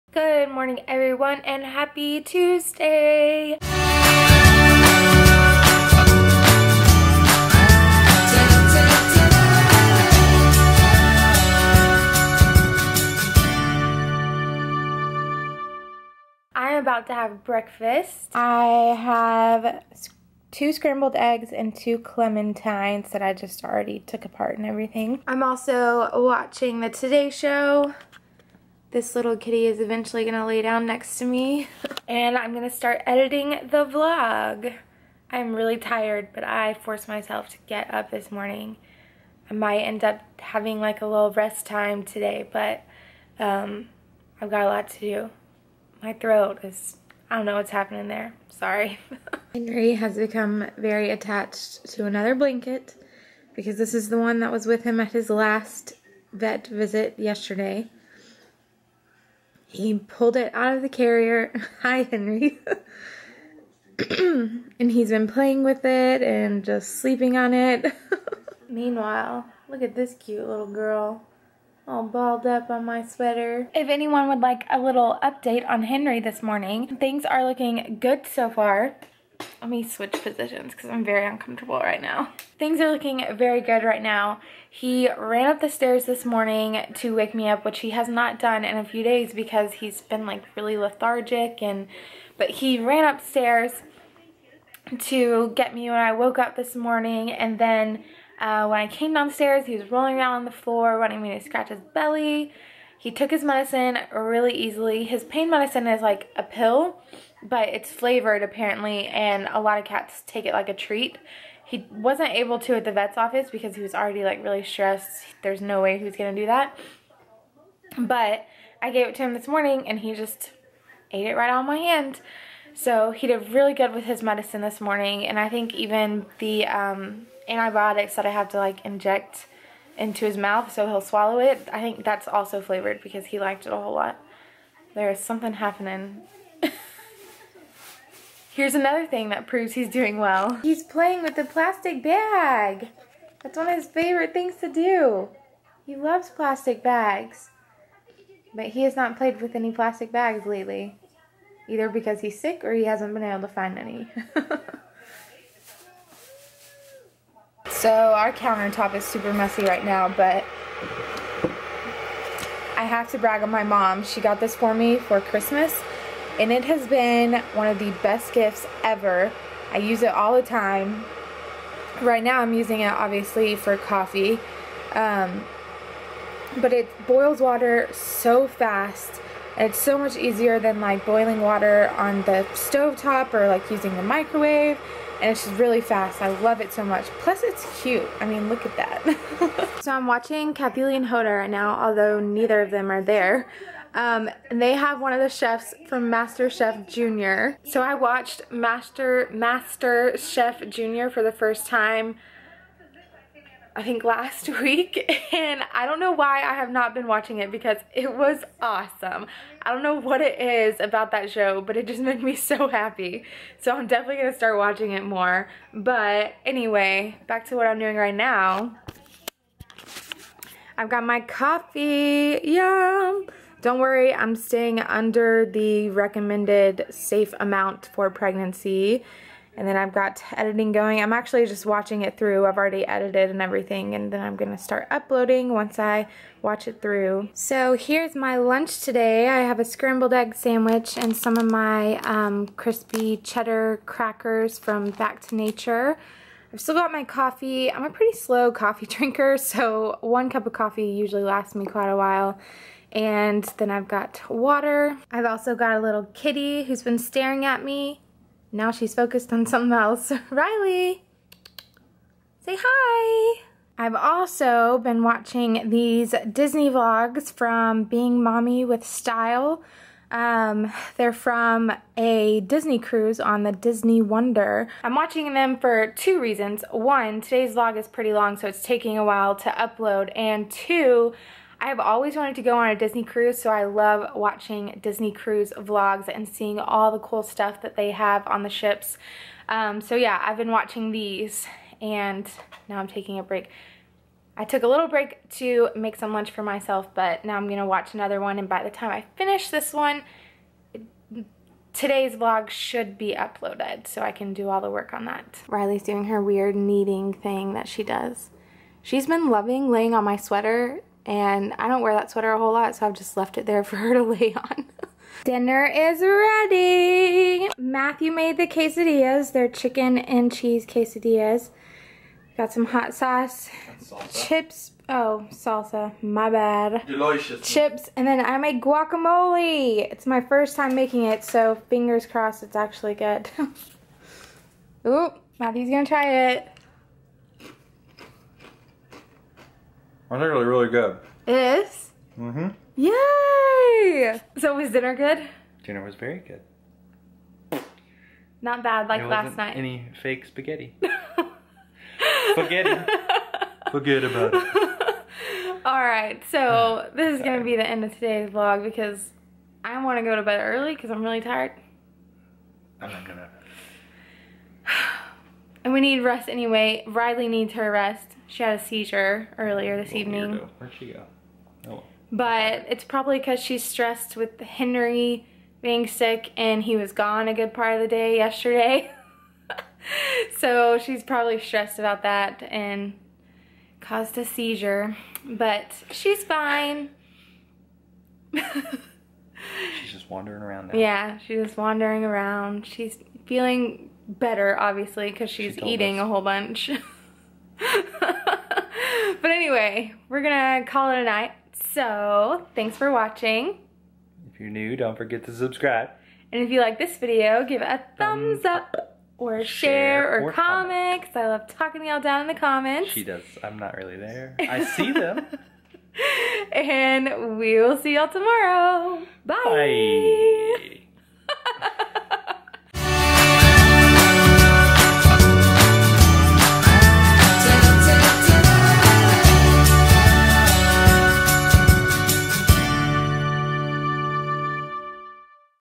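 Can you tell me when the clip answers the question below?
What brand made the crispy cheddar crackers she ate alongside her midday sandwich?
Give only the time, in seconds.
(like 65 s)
244 s.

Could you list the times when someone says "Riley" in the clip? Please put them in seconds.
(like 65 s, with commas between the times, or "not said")
260 s, 305 s, 366 s.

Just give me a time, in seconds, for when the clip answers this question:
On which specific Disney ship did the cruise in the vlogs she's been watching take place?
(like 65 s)
273 s.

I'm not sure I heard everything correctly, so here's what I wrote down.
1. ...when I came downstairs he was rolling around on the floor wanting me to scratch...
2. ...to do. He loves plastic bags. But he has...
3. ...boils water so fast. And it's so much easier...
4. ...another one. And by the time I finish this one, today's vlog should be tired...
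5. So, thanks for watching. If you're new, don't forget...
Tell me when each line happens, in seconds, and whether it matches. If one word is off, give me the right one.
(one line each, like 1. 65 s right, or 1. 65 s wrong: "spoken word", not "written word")
1. 98 s right
2. 144 s right
3. 177 s right
4. 297 s wrong: "uploaded", not "tired"
5. 401 s right.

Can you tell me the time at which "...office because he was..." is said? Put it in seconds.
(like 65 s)
113 s.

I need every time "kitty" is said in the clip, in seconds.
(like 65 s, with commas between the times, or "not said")
29 s, 256 s.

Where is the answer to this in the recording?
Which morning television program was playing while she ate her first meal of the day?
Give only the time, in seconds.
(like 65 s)
26 s.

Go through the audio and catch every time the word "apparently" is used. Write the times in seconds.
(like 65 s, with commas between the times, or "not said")
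108 s.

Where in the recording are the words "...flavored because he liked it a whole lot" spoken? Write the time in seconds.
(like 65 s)
132 s.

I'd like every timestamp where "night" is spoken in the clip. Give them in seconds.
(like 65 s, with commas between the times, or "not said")
349 s, 401 s.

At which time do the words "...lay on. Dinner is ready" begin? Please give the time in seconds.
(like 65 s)
314 s.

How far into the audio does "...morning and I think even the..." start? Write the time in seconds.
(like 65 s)
124 s.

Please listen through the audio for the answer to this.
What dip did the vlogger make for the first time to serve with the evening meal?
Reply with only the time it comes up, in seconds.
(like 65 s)
328 s.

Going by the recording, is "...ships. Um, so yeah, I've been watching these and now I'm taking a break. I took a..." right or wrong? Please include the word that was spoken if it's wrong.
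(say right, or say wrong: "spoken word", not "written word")
right.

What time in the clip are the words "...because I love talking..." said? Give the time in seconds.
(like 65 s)
411 s.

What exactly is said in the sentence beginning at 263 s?
I've also been watching these Disney vlogs from Being Mommy with Style.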